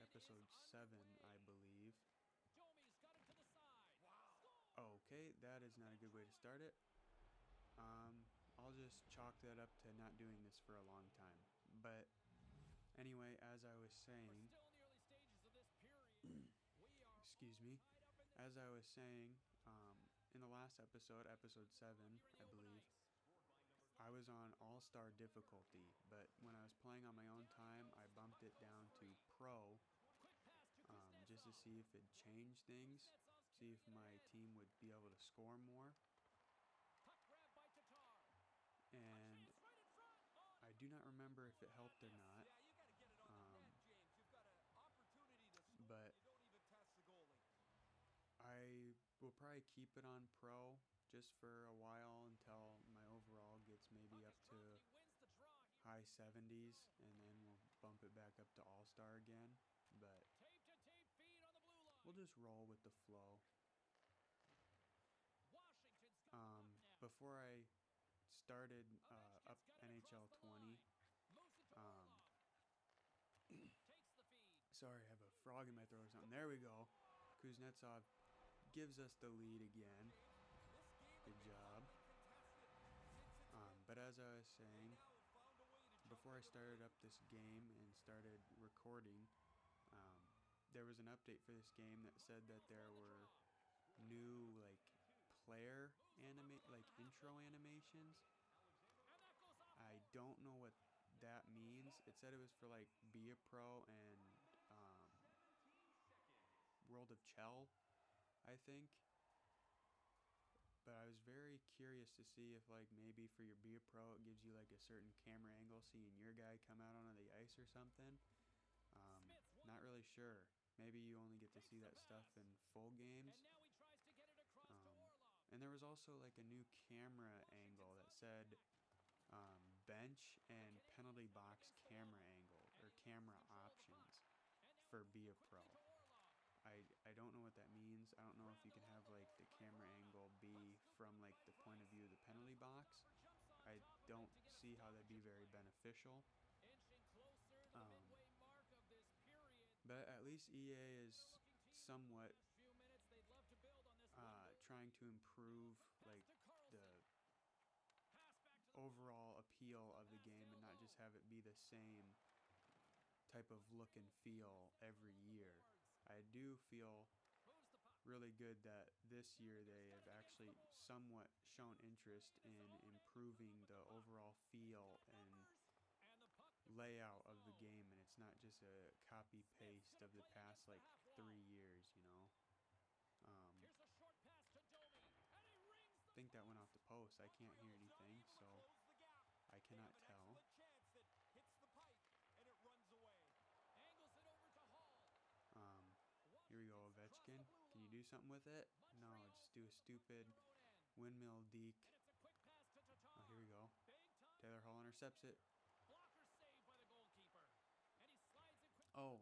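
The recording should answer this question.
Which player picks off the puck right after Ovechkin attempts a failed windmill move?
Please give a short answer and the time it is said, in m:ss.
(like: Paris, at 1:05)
Taylor Hall, at 3:24.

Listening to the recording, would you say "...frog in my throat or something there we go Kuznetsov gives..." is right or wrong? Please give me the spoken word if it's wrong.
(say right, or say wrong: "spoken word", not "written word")
right.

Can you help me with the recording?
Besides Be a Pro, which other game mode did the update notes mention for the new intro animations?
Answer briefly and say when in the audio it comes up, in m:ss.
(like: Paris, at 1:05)
World of CHEL, at 1:46.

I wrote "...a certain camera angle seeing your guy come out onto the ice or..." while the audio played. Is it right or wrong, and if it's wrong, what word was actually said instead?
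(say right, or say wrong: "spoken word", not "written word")
right.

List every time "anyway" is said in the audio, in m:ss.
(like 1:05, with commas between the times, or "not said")
0:12.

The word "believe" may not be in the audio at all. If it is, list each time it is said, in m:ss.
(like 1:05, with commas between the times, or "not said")
0:01, 0:22.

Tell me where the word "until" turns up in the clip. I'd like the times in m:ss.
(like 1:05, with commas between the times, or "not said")
0:52.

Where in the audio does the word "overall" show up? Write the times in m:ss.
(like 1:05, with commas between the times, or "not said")
0:53, 2:38, 2:53.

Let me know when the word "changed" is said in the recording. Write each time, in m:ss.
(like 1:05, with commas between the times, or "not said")
0:32.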